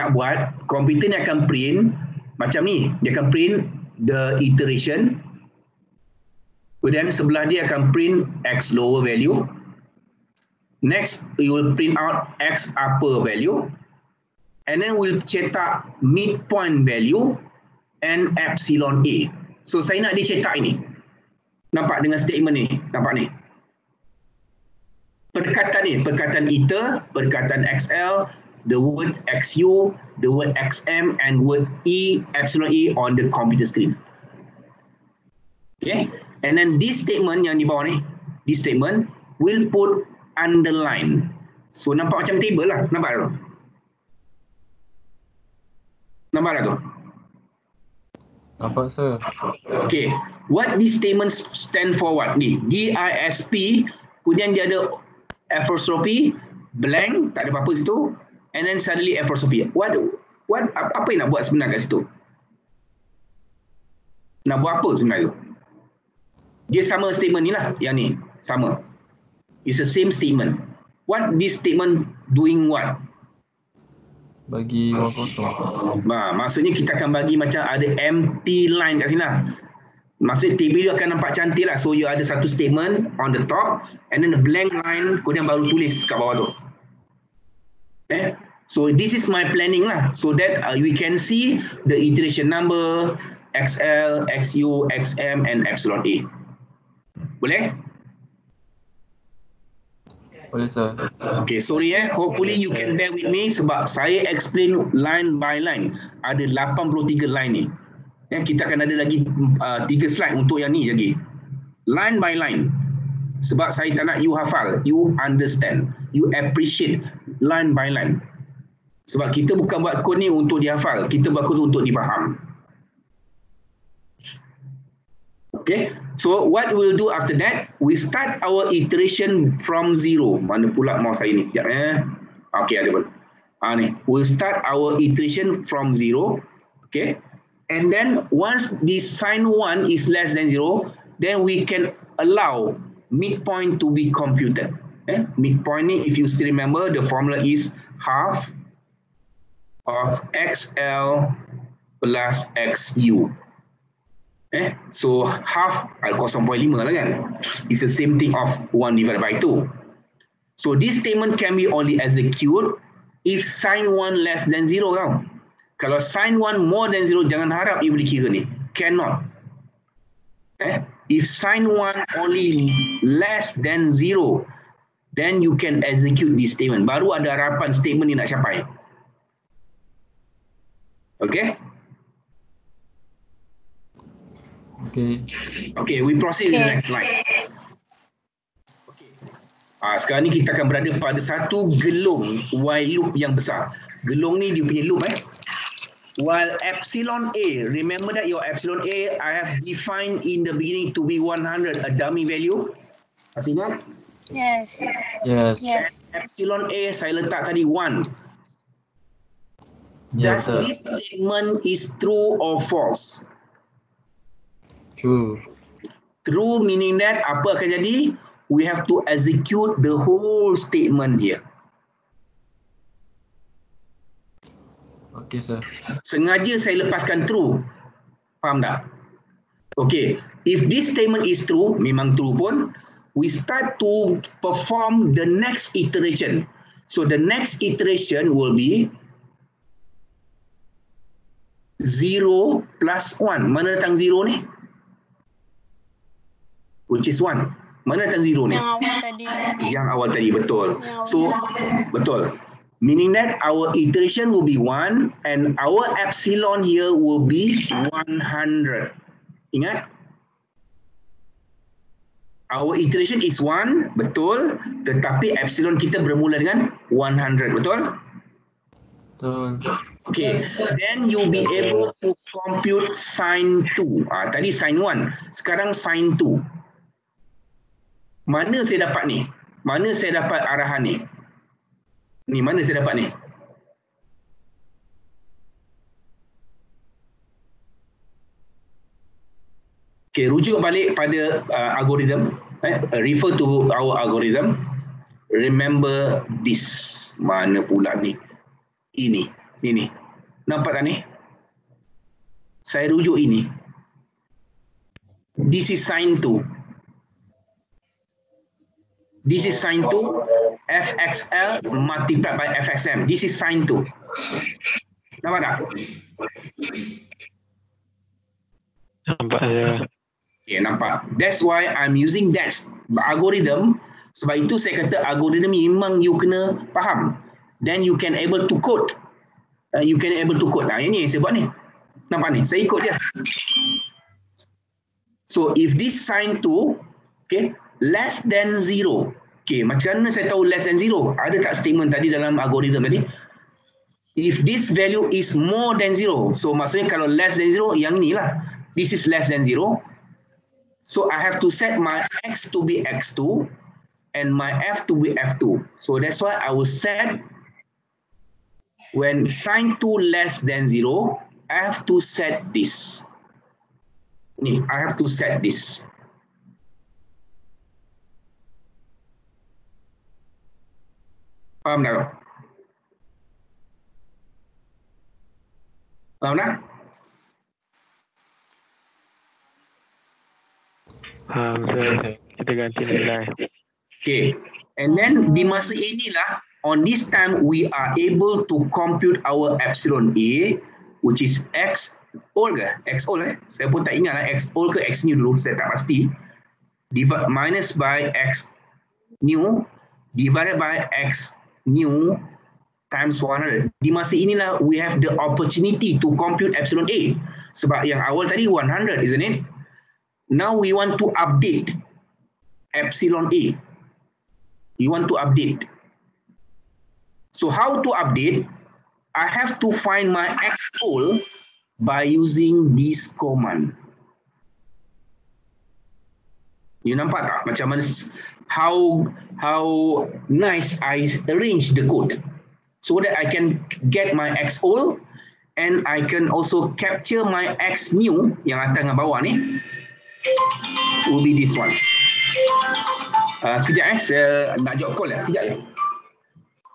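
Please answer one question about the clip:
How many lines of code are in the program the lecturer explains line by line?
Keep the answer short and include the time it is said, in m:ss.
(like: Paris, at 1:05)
83, at 1:46.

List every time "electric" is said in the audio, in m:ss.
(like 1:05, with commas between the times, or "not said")
not said.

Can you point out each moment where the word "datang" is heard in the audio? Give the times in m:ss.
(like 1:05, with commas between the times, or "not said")
4:03.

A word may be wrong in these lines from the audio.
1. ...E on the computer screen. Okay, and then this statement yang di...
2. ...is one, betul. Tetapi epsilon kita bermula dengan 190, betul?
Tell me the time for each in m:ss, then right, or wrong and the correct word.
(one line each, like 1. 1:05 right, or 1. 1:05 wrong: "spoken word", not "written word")
1. 0:32 right
2. 4:23 wrong: "100", not "190".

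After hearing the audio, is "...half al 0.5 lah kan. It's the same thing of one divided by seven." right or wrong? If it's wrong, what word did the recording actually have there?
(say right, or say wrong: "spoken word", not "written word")
wrong: "two", not "seven".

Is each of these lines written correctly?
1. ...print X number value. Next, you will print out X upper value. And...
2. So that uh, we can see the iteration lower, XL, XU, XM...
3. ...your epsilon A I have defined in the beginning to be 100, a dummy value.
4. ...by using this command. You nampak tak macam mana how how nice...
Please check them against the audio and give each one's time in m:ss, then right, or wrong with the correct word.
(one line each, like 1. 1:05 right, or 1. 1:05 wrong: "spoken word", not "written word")
1. 0:07 wrong: "lower", not "number"
2. 1:30 wrong: "number", not "lower"
3. 3:18 right
4. 7:01 right.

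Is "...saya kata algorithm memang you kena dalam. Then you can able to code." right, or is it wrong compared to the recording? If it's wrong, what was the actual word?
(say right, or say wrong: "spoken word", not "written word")
wrong: "faham", not "dalam".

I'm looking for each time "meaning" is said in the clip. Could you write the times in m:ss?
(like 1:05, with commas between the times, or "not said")
3:36, 4:12.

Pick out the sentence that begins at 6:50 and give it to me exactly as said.
Now we want to update epsilon A.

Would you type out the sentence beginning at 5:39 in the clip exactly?
Okay, macam mana saya tahu less than zero?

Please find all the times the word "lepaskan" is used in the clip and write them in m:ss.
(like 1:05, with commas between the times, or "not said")
3:46.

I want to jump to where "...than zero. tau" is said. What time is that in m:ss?
2:44.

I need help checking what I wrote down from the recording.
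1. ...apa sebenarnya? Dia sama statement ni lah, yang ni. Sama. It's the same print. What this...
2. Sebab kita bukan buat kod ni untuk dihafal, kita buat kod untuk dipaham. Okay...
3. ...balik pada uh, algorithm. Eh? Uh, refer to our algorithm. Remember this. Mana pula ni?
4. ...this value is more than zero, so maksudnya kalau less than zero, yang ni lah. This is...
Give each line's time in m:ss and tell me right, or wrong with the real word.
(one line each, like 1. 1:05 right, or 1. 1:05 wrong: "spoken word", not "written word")
1. 1:04 wrong: "statement", not "print"
2. 1:59 right
3. 4:50 right
4. 5:44 right.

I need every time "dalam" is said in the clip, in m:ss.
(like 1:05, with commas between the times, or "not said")
5:42.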